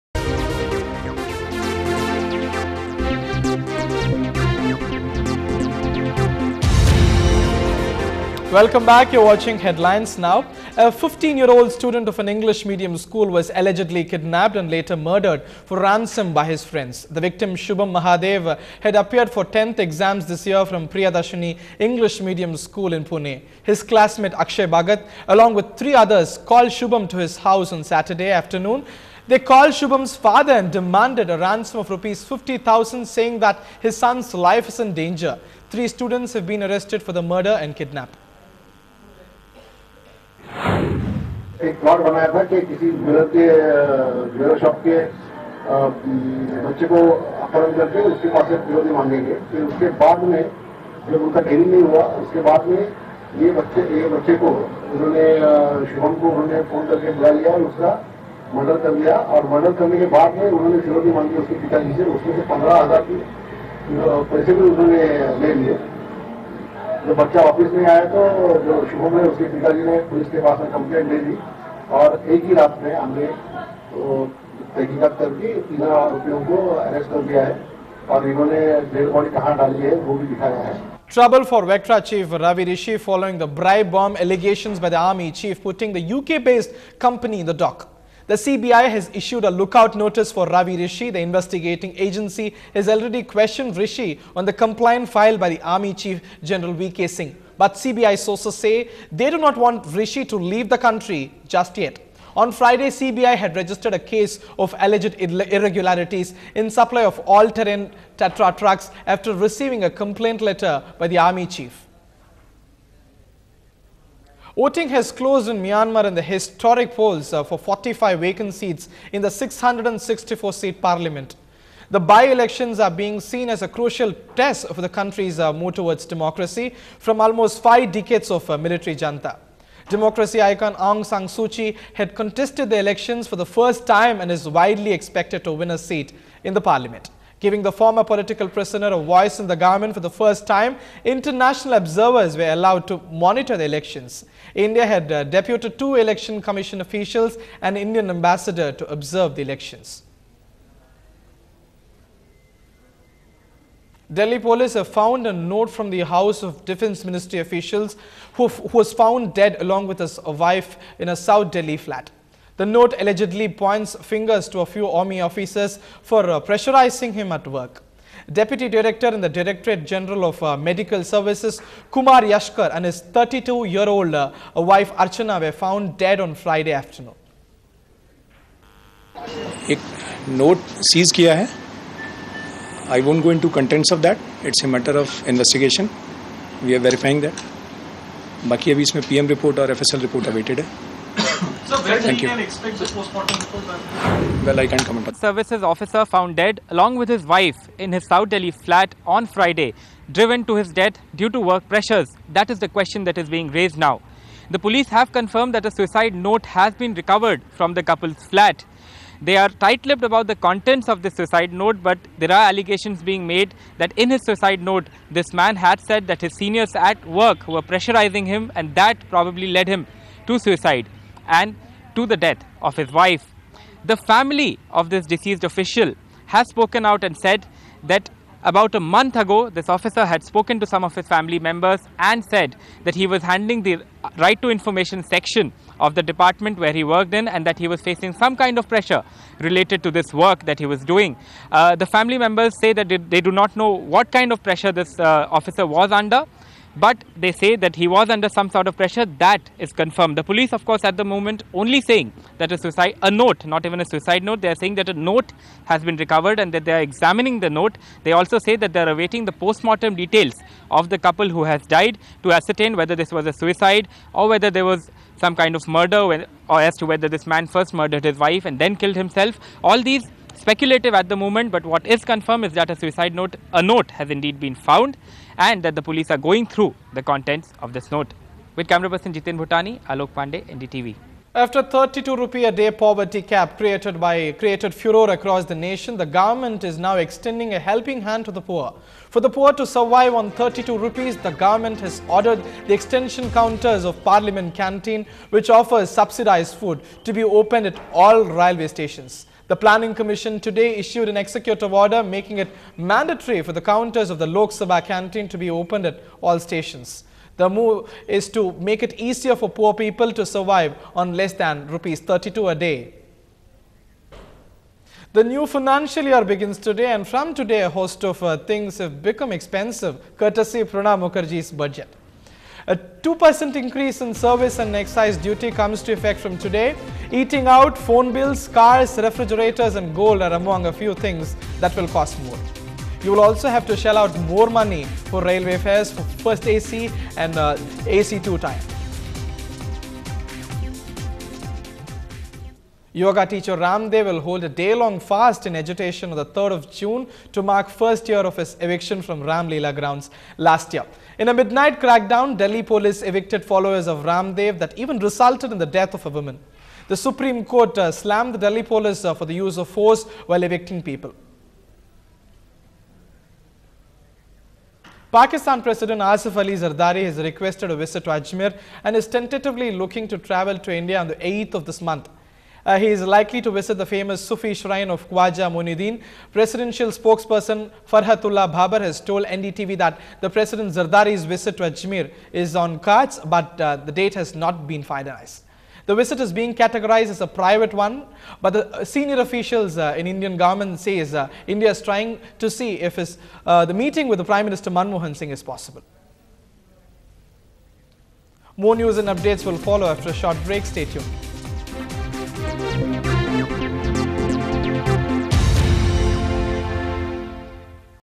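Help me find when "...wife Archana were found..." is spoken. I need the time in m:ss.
2:54.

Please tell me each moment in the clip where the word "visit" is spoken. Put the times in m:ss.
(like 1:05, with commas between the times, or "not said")
6:07, 6:13, 6:21, 6:25.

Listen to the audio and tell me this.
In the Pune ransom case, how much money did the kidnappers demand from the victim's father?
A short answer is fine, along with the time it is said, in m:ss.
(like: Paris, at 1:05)
Rs 50,000, at 0:31.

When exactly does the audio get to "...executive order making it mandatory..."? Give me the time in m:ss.
5:01.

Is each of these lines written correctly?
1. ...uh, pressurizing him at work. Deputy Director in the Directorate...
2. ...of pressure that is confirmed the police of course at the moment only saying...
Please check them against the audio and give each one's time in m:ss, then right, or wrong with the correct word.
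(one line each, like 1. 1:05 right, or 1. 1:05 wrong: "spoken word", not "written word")
1. 2:46 right
2. 4:08 right.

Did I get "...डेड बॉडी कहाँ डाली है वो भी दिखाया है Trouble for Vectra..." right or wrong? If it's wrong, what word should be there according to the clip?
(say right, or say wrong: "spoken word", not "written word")
right.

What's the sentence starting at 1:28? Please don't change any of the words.
The CBI has issued a lookout notice for Ravi Rishi.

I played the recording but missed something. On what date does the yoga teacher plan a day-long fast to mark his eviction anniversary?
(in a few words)
3rd of June.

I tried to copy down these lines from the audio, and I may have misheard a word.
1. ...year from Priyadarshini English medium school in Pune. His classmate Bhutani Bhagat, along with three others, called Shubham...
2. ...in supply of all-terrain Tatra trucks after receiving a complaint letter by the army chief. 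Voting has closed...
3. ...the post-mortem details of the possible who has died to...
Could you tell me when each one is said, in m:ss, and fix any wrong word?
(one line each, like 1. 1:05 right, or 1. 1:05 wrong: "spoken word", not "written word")
1. 0:20 wrong: "Akshay", not "Bhutani"
2. 1:46 right
3. 4:19 wrong: "couple", not "possible".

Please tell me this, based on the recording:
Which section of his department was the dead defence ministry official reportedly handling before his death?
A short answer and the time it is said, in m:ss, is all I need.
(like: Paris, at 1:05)
Right to information, at 3:54.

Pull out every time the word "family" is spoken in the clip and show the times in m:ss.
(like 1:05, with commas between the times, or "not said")
3:43, 3:51, 4:01.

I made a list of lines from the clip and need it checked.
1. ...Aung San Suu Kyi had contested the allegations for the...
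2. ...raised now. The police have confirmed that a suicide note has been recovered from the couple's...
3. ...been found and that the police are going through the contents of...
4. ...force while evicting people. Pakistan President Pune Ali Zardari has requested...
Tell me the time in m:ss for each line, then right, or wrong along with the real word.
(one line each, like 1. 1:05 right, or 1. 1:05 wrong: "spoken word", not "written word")
1. 2:10 wrong: "elections", not "allegations"
2. 3:23 right
3. 4:34 right
4. 5:59 wrong: "Asif", not "Pune".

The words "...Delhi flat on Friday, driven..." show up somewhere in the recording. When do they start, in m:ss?
3:18.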